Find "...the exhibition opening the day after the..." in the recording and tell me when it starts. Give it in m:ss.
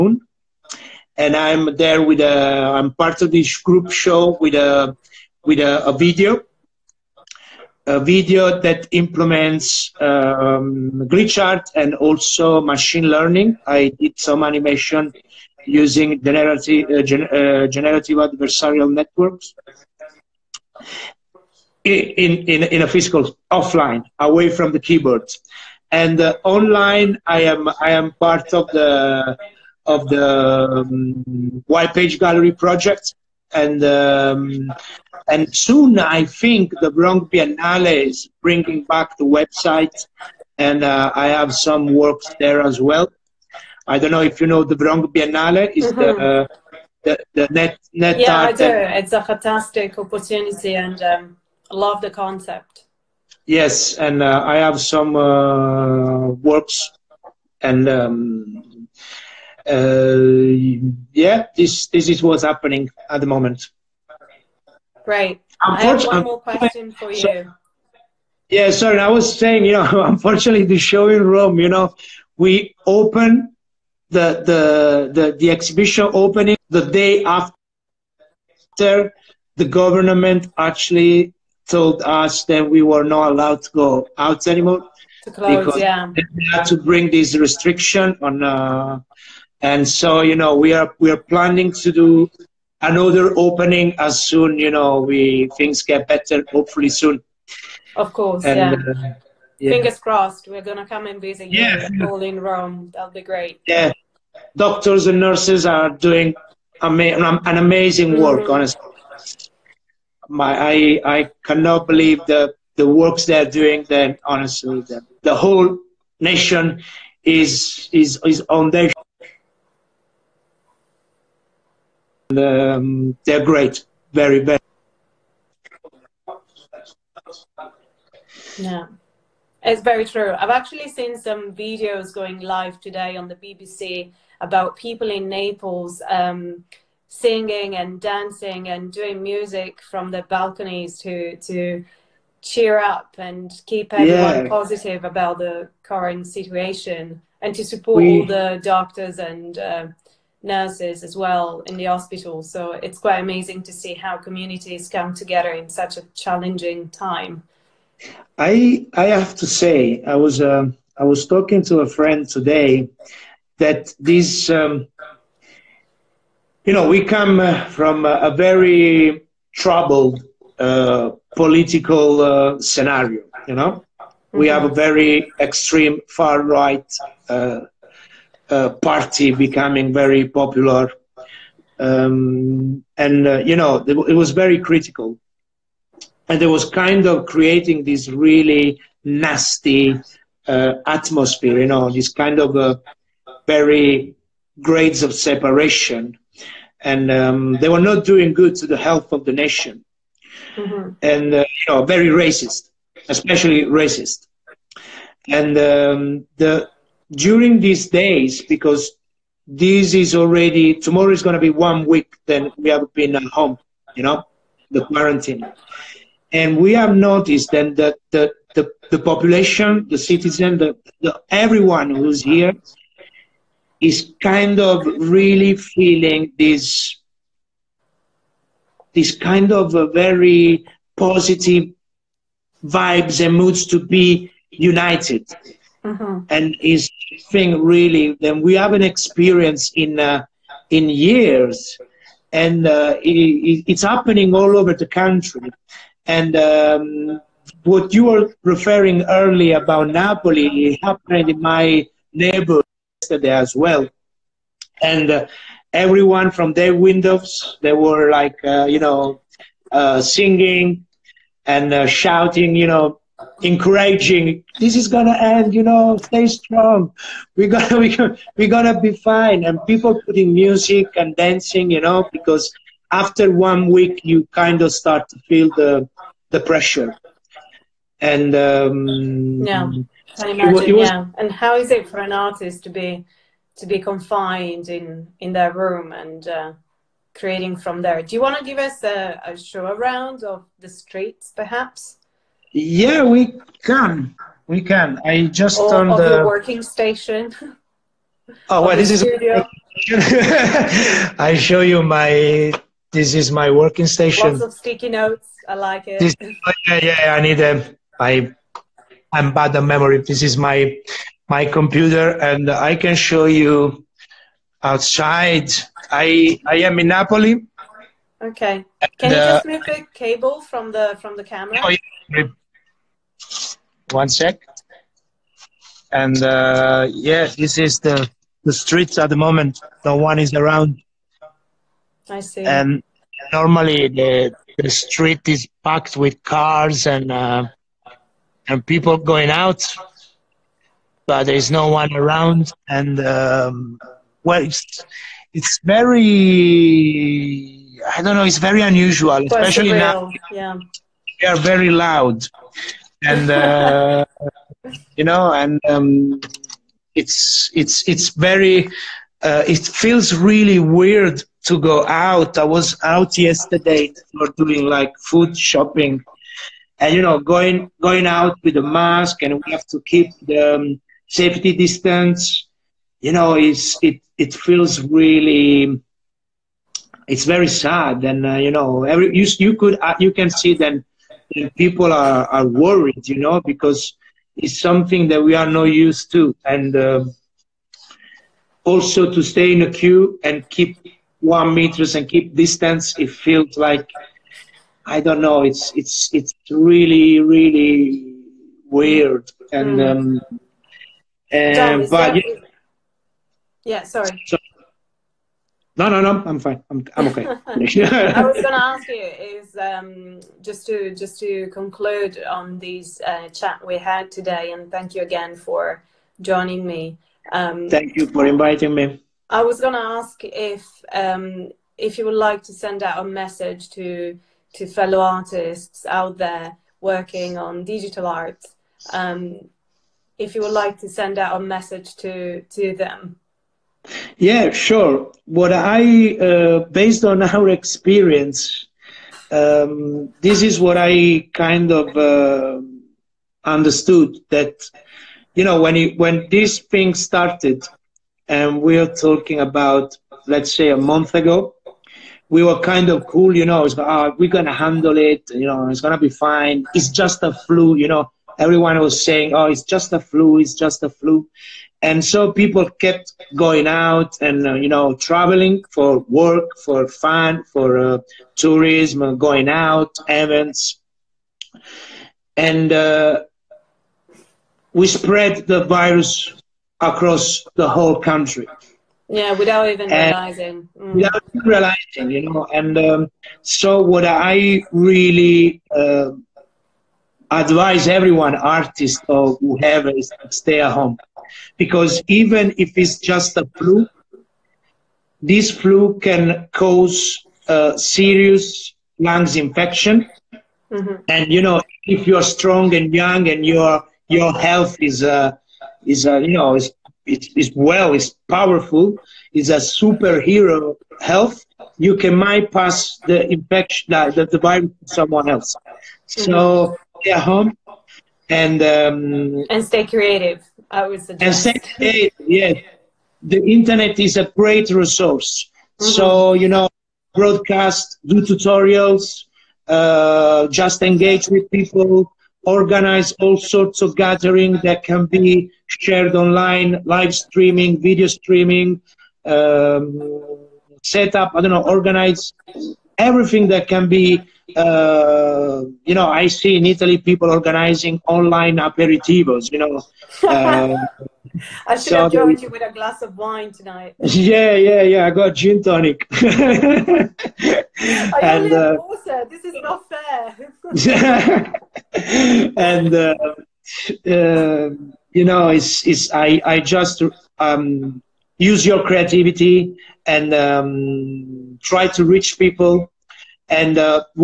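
1:15.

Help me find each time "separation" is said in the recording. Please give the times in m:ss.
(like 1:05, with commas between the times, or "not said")
3:15.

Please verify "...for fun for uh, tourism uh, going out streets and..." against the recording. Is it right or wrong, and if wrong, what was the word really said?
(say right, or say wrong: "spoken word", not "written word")
wrong: "events", not "streets".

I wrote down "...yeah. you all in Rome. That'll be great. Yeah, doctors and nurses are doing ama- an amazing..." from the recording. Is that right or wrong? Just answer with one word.
right.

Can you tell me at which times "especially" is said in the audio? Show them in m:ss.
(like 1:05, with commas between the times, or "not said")
3:23, 5:49.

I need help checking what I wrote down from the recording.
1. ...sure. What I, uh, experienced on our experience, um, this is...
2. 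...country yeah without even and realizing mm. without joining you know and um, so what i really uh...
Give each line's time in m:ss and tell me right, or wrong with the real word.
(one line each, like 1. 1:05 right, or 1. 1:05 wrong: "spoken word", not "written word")
1. 7:14 wrong: "based", not "experienced"
2. 7:57 wrong: "realizing", not "joining".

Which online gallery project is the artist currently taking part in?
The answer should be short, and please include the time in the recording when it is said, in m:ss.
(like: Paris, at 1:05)
White Page Gallery, at 0:31.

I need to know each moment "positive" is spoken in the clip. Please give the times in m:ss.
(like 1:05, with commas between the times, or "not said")
2:24, 3:50.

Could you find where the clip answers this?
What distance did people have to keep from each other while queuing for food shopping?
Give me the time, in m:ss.
6:31.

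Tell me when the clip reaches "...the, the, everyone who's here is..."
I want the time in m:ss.
3:40.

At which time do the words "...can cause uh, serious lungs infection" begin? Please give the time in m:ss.
8:15.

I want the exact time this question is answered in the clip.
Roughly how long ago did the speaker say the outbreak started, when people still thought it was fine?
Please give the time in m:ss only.
7:30.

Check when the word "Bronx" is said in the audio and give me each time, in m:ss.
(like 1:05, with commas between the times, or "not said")
0:36, 0:44.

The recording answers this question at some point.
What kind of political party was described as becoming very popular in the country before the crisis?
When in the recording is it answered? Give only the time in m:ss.
2:55.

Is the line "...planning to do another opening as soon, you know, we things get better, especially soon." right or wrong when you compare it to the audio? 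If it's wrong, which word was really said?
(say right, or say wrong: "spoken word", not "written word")
wrong: "hopefully", not "especially".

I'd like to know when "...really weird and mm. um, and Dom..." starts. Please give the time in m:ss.
6:37.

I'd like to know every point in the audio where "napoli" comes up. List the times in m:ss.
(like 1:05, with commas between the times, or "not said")
4:09, 5:16.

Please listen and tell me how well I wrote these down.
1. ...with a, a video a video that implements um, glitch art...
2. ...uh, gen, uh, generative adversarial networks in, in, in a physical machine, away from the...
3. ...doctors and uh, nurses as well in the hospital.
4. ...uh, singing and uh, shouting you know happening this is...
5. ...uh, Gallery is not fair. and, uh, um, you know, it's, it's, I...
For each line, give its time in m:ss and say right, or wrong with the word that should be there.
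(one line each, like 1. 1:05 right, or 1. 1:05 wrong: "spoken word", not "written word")
1. 0:05 right
2. 0:16 wrong: "offline", not "machine"
3. 2:28 right
4. 4:19 wrong: "encouraging", not "happening"
5. 9:18 wrong: "This", not "Gallery".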